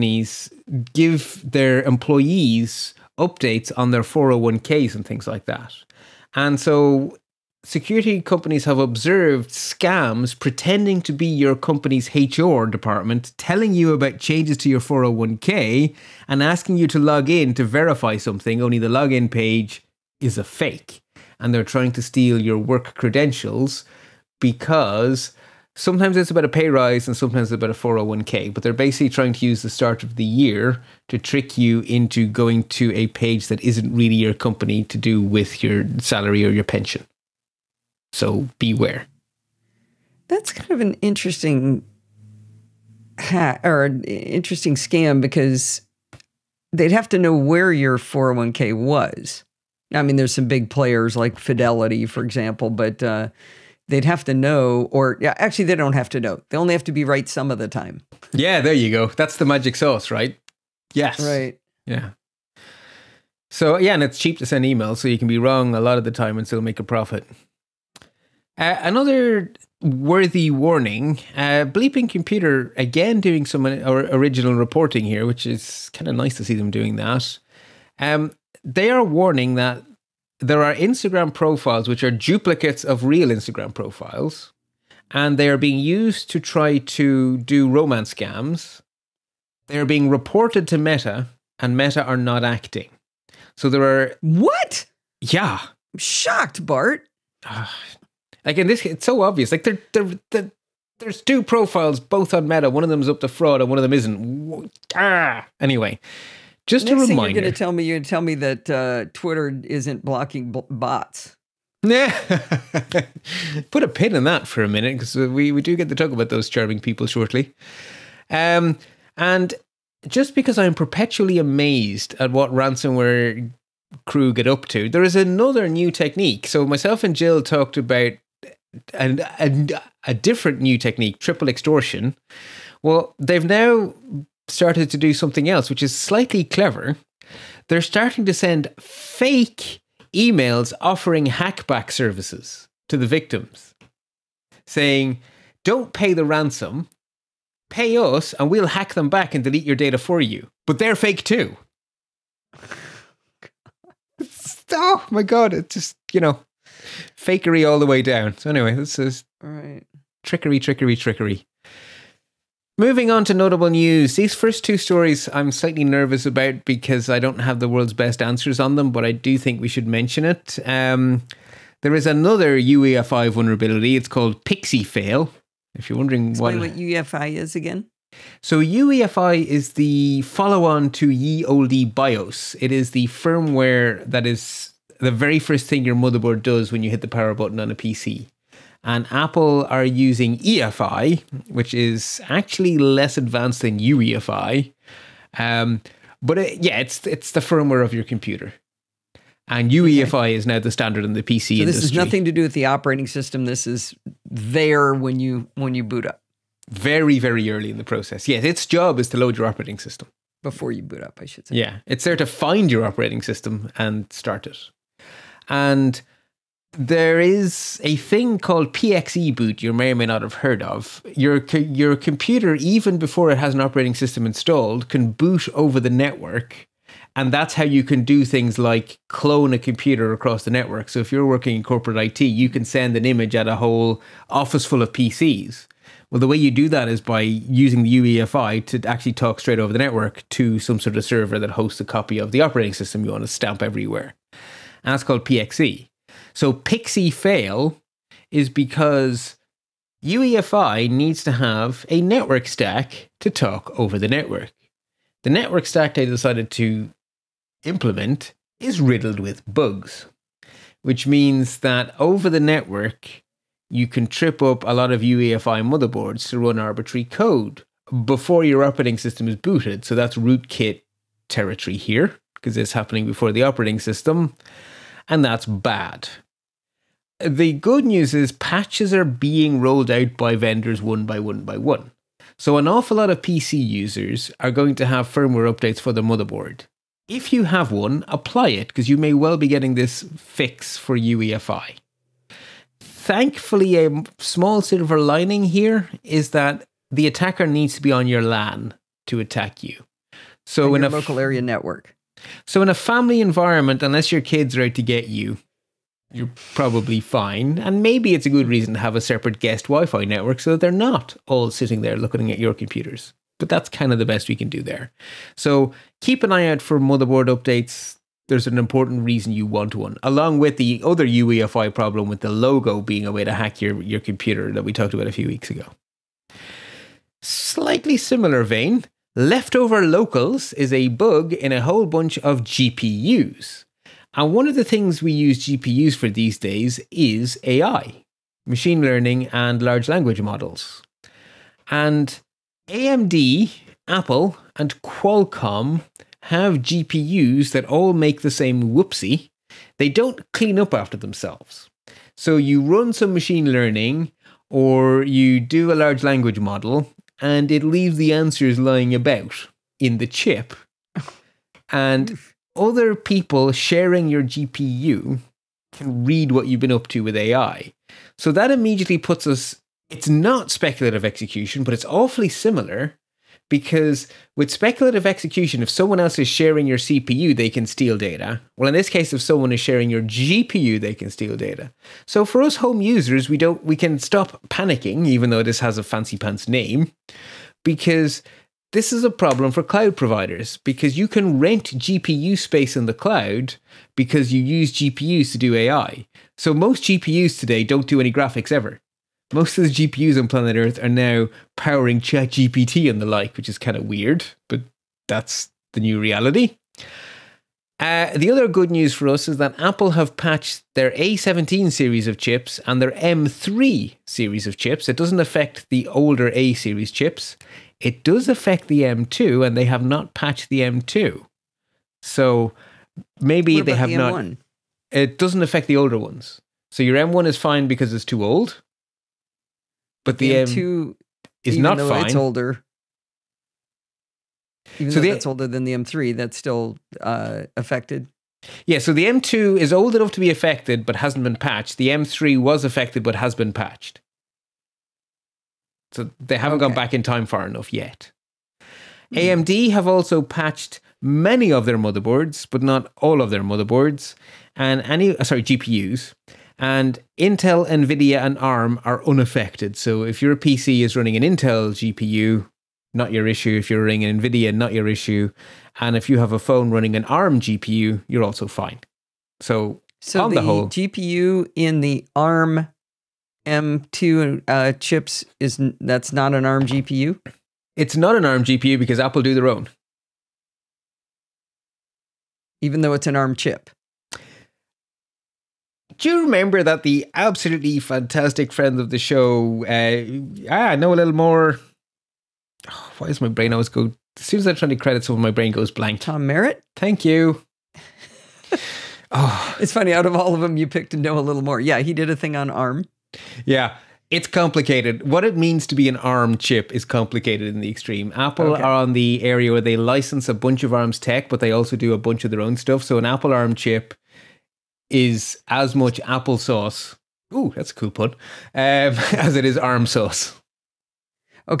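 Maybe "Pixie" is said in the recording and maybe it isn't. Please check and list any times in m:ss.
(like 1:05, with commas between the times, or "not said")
2:54, 4:06.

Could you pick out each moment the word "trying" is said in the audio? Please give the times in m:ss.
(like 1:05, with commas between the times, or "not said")
0:21, 0:29.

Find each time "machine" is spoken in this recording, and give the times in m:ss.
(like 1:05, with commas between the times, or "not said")
5:38, 5:53.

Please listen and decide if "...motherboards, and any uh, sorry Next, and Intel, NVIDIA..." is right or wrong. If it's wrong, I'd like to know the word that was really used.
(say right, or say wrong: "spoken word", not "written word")
wrong: "GPUs", not "Next".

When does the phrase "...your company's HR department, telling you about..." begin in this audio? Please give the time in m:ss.
0:11.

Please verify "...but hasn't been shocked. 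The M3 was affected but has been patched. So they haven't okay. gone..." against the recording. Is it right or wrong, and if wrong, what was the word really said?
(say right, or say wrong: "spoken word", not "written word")
wrong: "patched", not "shocked".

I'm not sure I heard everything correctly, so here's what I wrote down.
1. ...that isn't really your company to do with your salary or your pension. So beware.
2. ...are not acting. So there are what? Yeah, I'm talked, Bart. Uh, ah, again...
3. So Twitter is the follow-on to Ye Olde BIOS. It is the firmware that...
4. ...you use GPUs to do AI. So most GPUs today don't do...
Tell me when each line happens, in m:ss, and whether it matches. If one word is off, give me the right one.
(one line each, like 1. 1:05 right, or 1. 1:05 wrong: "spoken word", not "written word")
1. 0:33 right
2. 1:32 wrong: "shocked", not "talked"
3. 2:58 wrong: "UEFI", not "Twitter"
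4. 6:34 right.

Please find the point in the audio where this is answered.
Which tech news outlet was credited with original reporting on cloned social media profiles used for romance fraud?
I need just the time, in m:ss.
1:11.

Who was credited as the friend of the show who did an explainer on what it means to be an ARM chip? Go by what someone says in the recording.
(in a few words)
Tom Merritt.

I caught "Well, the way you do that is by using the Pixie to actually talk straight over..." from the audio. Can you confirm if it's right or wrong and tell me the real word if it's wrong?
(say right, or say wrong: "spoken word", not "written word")
wrong: "UEFI", not "Pixie".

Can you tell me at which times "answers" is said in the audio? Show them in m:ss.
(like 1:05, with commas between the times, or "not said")
2:48, 5:58.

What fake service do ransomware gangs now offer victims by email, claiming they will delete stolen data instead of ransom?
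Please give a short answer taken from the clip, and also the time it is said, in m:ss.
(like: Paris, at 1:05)
hackback services, at 2:21.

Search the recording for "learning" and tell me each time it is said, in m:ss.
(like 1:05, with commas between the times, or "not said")
5:38, 5:53.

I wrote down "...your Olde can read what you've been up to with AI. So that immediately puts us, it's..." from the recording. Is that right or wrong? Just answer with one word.
wrong.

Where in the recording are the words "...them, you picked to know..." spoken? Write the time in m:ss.
8:20.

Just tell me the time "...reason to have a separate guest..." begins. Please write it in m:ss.
5:08.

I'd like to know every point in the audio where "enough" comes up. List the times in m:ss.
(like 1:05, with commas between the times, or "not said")
7:19, 7:27.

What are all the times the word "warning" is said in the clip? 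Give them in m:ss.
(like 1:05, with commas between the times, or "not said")
1:10, 1:19.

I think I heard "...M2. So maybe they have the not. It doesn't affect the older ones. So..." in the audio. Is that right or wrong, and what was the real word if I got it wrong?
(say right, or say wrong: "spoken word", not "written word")
right.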